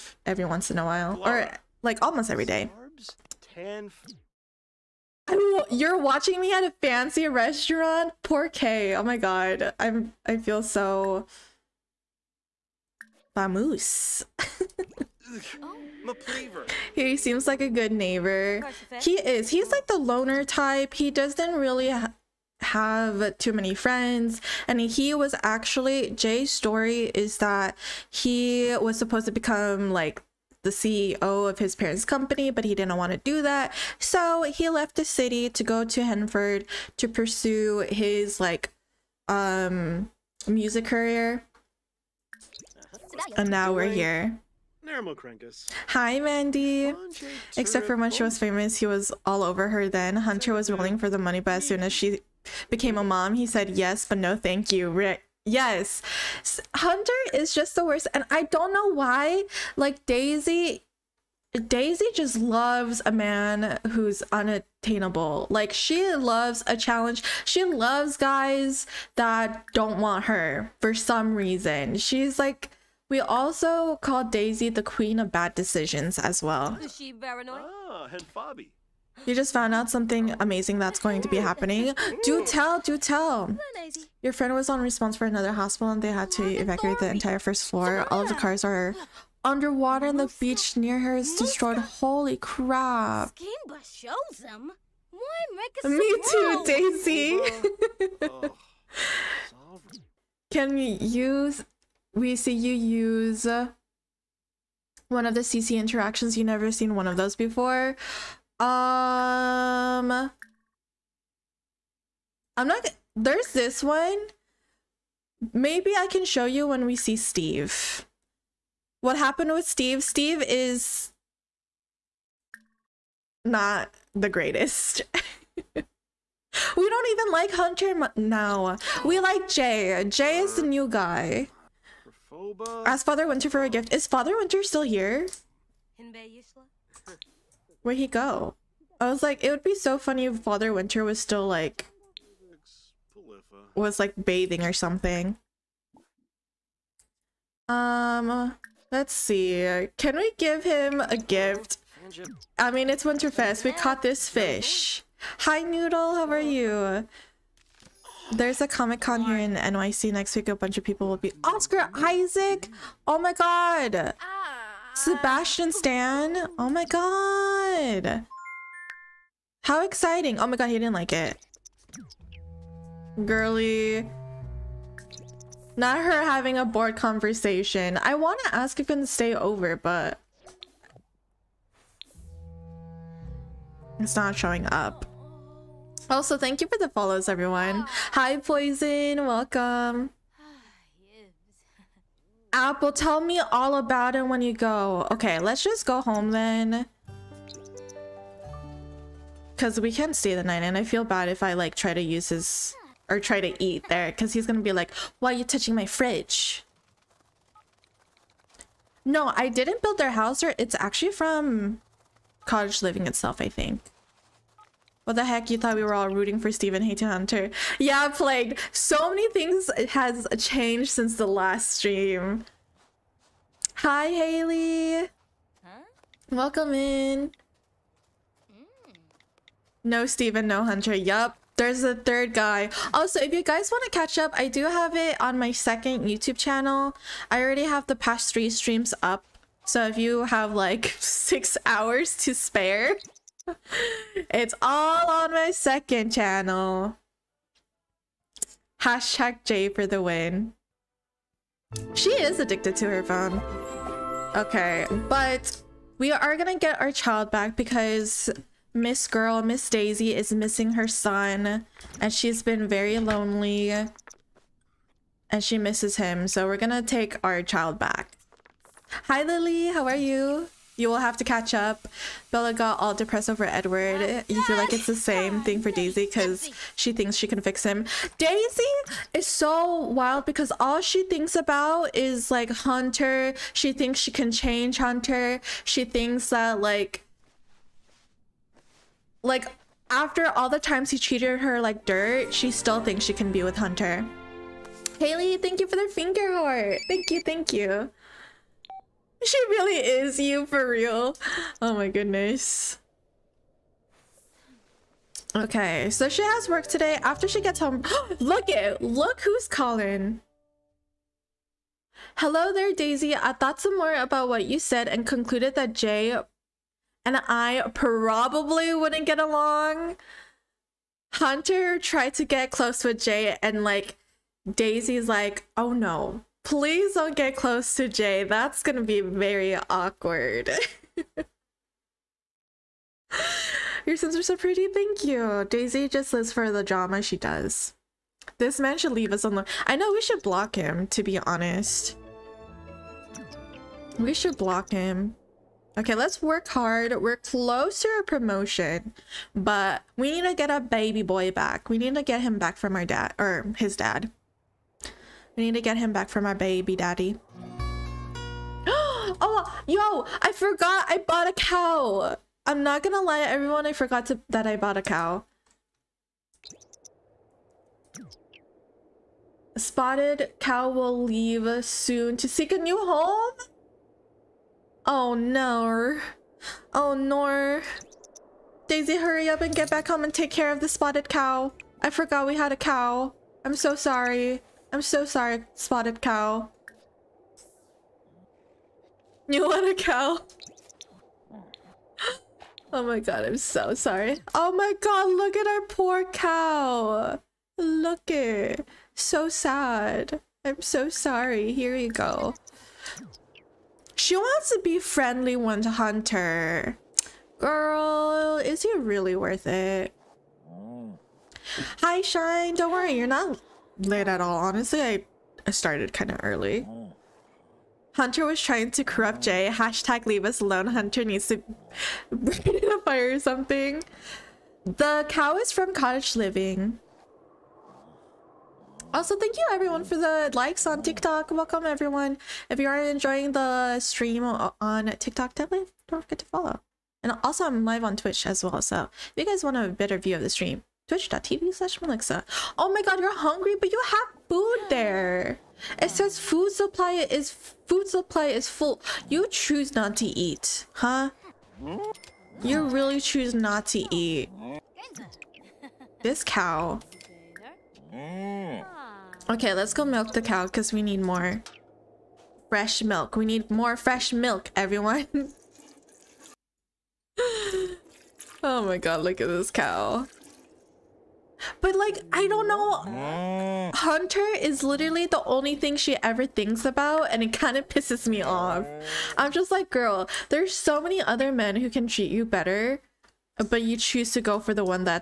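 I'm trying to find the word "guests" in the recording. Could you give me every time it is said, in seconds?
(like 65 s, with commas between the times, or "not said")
not said.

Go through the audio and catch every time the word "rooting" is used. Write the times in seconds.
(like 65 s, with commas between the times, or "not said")
216 s.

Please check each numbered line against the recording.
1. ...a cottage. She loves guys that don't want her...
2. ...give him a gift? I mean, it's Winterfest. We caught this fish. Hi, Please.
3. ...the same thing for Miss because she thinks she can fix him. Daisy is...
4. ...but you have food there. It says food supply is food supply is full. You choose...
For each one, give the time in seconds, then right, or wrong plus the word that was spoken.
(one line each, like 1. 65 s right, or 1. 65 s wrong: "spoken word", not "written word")
1. 66 s wrong: "challenge", not "cottage"
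2. 150 s wrong: "Noodle", not "Please"
3. 274 s wrong: "Daisy", not "Miss"
4. 443 s right.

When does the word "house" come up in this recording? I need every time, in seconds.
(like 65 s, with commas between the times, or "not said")
210 s.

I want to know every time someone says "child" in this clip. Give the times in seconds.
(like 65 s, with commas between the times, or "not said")
256 s, 267 s.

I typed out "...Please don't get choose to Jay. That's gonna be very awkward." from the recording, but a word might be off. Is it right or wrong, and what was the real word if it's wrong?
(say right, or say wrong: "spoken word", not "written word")
wrong: "close", not "choose".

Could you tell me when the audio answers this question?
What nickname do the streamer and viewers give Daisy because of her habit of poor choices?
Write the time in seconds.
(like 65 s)
74 s.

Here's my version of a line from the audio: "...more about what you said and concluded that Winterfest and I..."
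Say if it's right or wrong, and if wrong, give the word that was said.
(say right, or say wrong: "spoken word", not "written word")
wrong: "Jay", not "Winterfest".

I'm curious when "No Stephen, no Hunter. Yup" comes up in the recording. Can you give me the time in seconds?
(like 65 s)
229 s.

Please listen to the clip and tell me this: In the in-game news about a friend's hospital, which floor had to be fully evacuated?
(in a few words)
first floor.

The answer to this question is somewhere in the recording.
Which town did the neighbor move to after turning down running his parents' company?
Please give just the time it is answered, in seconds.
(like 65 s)
36 s.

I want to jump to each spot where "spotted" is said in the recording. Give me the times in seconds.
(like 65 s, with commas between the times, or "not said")
369 s, 380 s, 385 s.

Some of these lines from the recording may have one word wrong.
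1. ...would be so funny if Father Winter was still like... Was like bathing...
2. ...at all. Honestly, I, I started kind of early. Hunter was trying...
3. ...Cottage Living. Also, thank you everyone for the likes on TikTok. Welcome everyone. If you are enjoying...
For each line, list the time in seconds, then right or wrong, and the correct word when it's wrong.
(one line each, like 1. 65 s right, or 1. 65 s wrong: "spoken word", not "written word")
1. 139 s right
2. 414 s right
3. 425 s right.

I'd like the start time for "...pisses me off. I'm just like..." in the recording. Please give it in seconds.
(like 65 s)
477 s.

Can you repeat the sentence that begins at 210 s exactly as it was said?
Or it's actually from cottage living itself, I think.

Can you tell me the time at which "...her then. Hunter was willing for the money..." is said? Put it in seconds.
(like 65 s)
49 s.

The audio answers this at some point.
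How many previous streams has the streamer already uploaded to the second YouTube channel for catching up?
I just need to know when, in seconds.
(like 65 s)
238 s.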